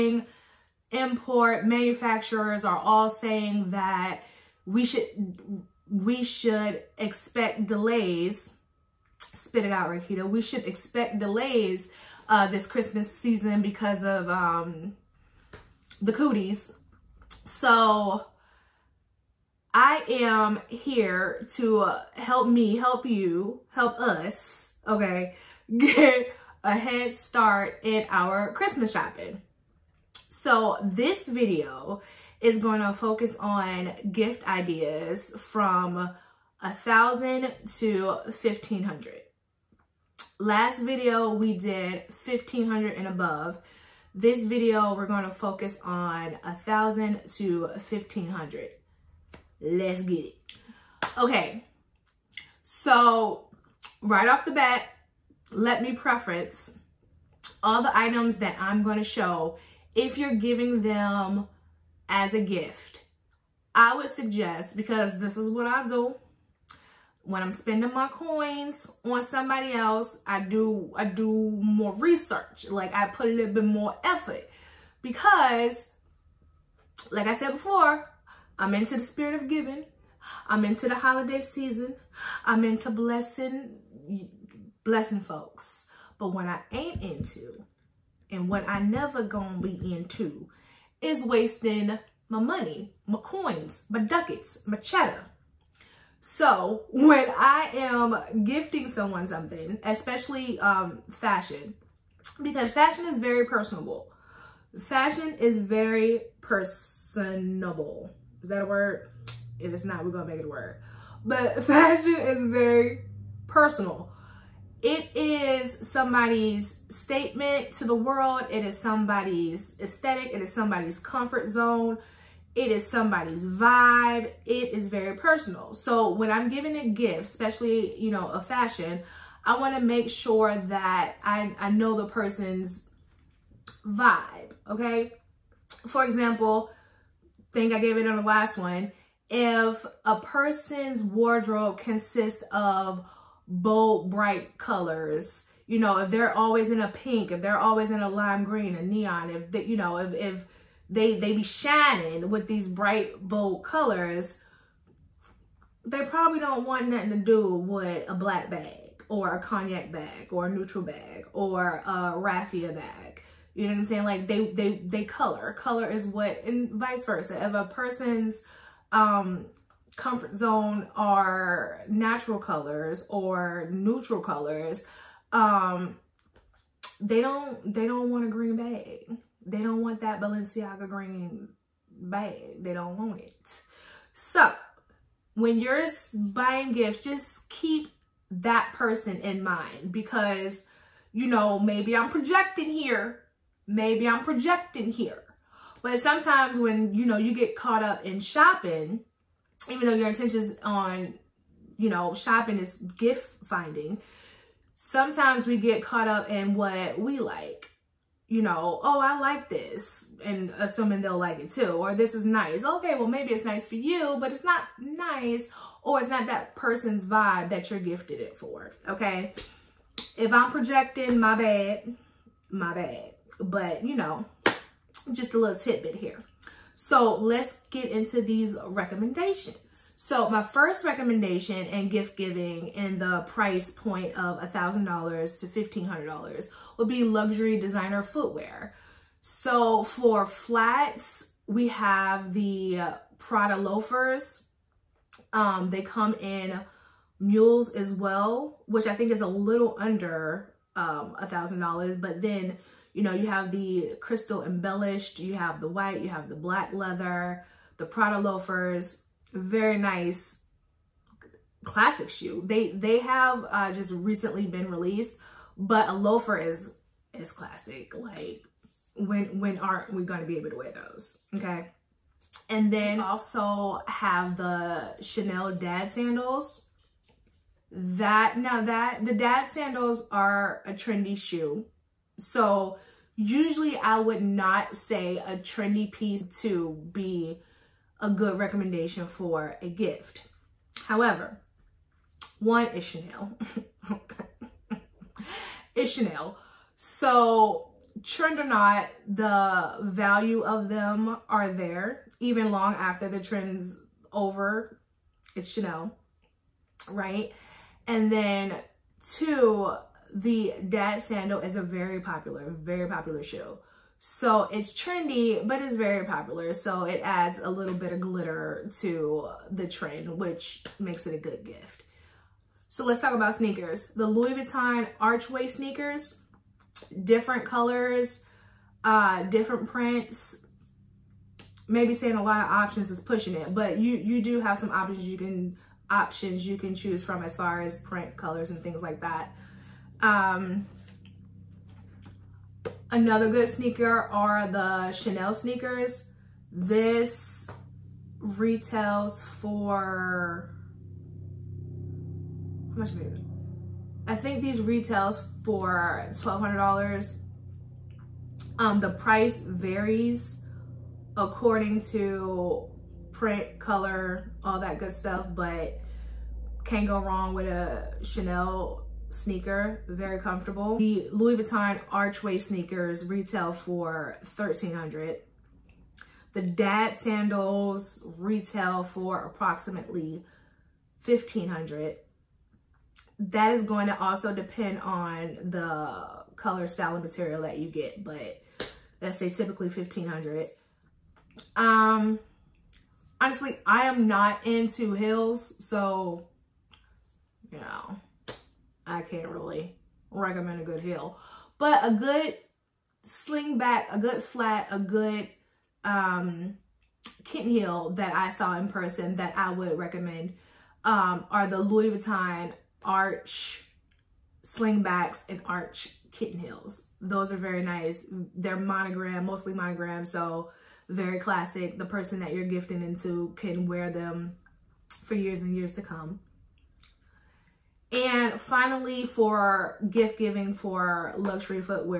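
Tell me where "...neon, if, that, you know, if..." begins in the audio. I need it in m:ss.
2:28.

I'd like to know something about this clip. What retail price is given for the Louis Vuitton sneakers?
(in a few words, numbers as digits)
1300.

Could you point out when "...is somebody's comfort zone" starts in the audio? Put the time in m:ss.
2:00.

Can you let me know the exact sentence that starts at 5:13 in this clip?
So it's trendy, but it's very popular.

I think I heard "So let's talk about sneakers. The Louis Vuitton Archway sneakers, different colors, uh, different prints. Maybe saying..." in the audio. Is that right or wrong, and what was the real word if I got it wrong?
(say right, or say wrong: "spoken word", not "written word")
right.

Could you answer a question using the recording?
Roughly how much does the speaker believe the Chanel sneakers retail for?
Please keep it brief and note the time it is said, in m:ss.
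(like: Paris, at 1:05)
$1,200, at 5:56.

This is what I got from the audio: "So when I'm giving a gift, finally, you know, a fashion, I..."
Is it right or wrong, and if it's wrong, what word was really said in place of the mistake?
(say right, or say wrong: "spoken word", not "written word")
wrong: "especially", not "finally".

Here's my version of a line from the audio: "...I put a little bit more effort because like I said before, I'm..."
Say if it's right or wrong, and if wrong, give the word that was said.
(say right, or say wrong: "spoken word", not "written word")
right.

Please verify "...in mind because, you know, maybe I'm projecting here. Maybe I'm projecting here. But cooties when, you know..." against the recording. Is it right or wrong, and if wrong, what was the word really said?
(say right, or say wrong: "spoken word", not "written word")
wrong: "sometimes", not "cooties".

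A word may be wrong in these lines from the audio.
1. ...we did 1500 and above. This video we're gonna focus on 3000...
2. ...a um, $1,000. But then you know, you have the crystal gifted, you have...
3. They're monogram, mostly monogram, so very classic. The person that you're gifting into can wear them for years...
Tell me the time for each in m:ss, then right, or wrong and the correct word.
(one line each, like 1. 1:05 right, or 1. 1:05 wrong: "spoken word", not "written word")
1. 0:41 wrong: "1000", not "3000"
2. 4:11 wrong: "embellished", not "gifted"
3. 6:58 right.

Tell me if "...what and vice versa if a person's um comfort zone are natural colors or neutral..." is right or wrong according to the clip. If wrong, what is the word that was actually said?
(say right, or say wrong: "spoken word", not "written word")
right.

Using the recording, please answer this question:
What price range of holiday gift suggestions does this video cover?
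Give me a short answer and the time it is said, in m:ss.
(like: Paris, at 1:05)
$1,000 to $1,500, at 0:36.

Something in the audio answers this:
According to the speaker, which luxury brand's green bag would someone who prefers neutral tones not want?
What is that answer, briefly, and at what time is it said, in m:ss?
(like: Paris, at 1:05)
Balenciaga, at 3:00.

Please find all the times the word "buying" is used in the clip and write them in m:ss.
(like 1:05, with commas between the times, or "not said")
3:06.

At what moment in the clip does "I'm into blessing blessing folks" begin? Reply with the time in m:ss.
1:22.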